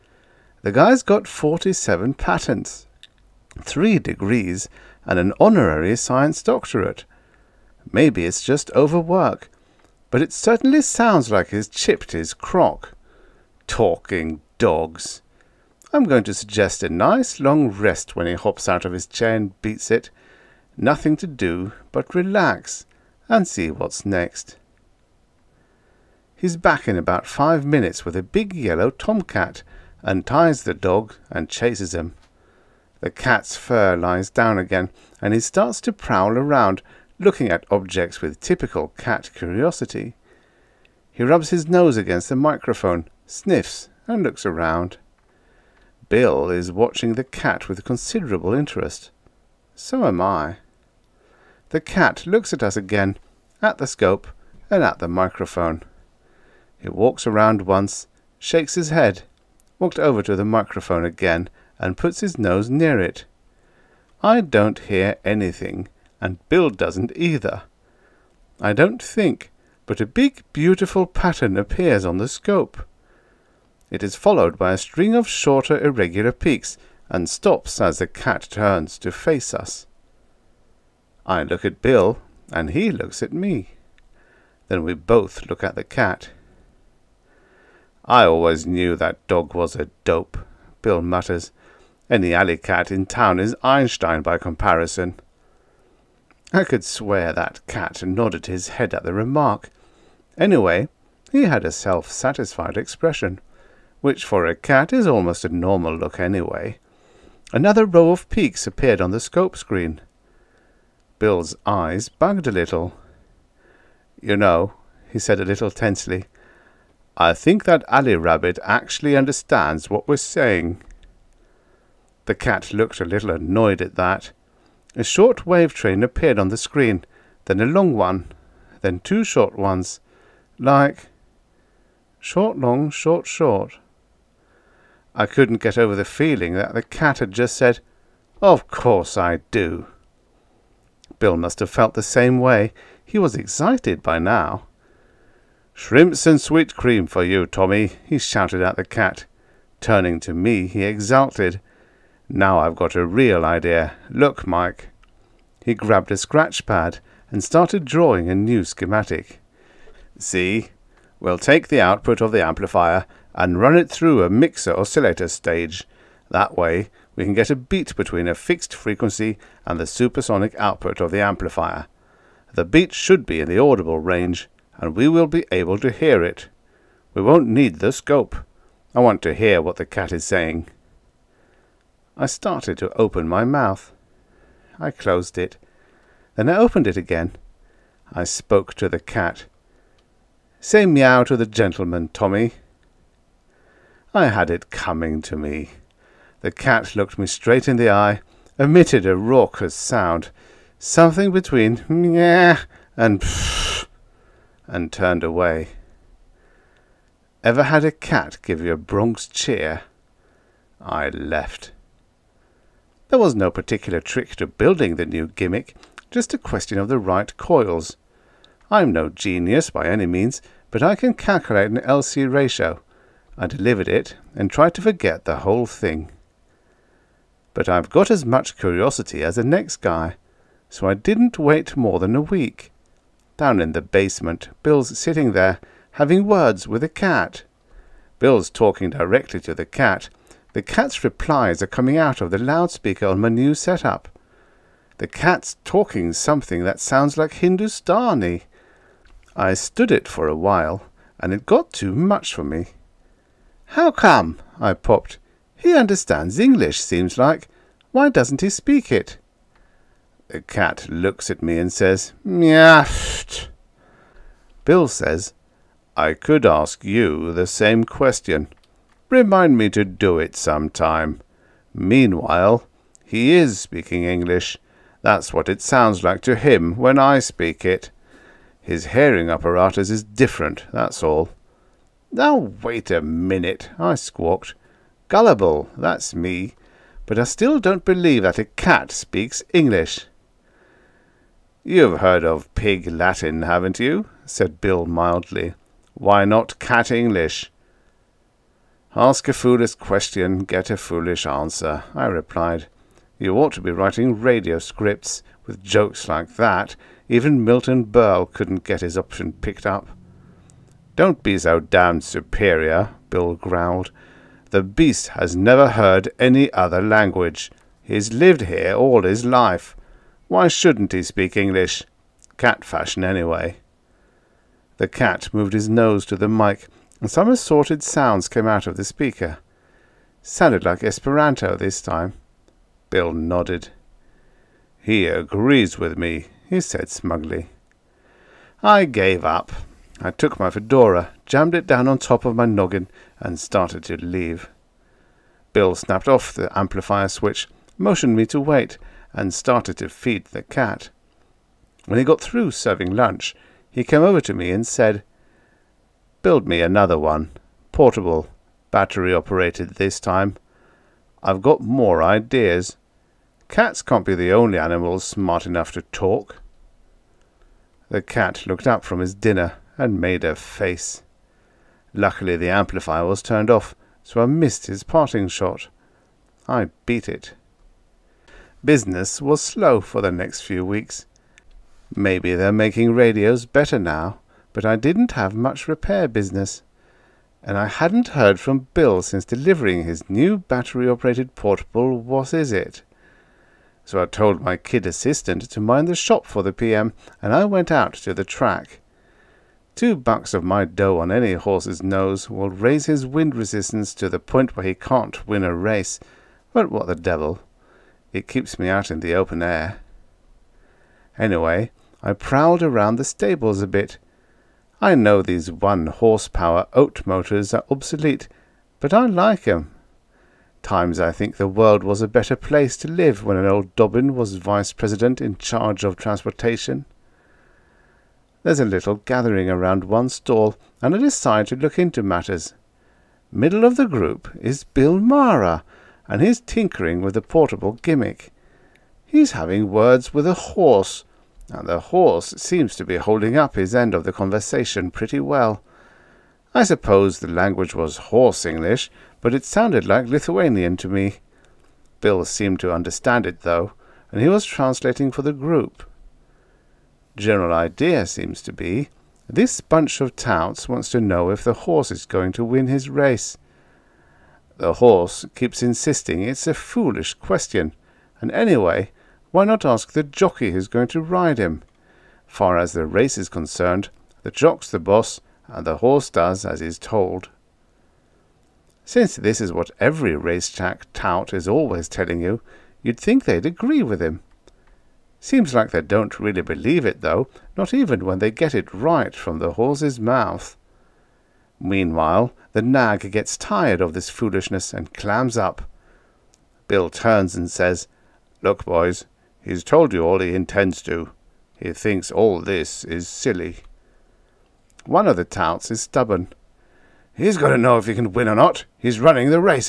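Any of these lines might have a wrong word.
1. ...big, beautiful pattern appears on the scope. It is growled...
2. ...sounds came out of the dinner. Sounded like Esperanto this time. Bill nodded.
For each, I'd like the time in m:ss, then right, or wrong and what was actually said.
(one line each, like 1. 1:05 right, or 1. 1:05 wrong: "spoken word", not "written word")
1. 1:10 wrong: "followed", not "growled"
2. 5:27 wrong: "speaker", not "dinner".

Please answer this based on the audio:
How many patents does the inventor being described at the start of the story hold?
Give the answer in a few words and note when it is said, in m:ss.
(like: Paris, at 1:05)
47, at 0:01.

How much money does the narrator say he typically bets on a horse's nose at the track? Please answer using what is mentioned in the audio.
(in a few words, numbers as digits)
2 bucks.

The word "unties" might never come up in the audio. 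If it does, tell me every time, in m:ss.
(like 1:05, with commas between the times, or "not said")
0:30.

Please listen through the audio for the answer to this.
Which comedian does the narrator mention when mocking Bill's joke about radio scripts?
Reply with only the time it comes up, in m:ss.
5:07.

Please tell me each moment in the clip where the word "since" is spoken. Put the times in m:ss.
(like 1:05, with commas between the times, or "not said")
6:29, 7:58.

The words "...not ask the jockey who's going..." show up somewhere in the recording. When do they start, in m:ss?
7:49.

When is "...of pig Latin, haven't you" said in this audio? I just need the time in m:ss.
4:52.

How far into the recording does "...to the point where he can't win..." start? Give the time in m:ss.
6:43.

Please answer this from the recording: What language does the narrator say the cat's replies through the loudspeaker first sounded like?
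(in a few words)
Hindustani.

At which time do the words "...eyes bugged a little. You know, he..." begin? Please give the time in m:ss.
1:51.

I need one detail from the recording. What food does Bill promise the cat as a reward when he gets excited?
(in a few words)
Shrimps and sweet cream.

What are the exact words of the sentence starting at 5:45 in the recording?
Bill snapped off the amplifier switch, motioned me to wait, and started to feed the cat.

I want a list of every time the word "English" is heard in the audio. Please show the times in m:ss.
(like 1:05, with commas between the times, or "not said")
4:16, 4:34, 4:49, 4:56, 5:21, 7:28.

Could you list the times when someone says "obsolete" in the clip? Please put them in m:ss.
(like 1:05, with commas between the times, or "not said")
6:57.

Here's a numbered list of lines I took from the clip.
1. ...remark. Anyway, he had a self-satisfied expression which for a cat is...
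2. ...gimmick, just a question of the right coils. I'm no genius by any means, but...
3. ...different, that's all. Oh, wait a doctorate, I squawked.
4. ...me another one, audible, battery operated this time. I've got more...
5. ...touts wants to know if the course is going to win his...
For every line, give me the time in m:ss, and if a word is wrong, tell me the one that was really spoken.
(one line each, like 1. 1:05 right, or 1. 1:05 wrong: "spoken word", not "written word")
1. 1:39 right
2. 3:35 right
3. 4:40 wrong: "minute", not "doctorate"
4. 5:56 wrong: "portable", not "audible"
5. 7:40 wrong: "horse", not "course".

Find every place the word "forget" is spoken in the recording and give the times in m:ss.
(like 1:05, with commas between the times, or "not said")
3:44.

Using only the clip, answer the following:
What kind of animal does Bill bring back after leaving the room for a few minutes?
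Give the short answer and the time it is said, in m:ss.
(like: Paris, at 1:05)
tomcat, at 0:28.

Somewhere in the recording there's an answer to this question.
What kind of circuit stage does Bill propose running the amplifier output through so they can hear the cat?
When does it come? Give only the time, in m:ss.
2:44.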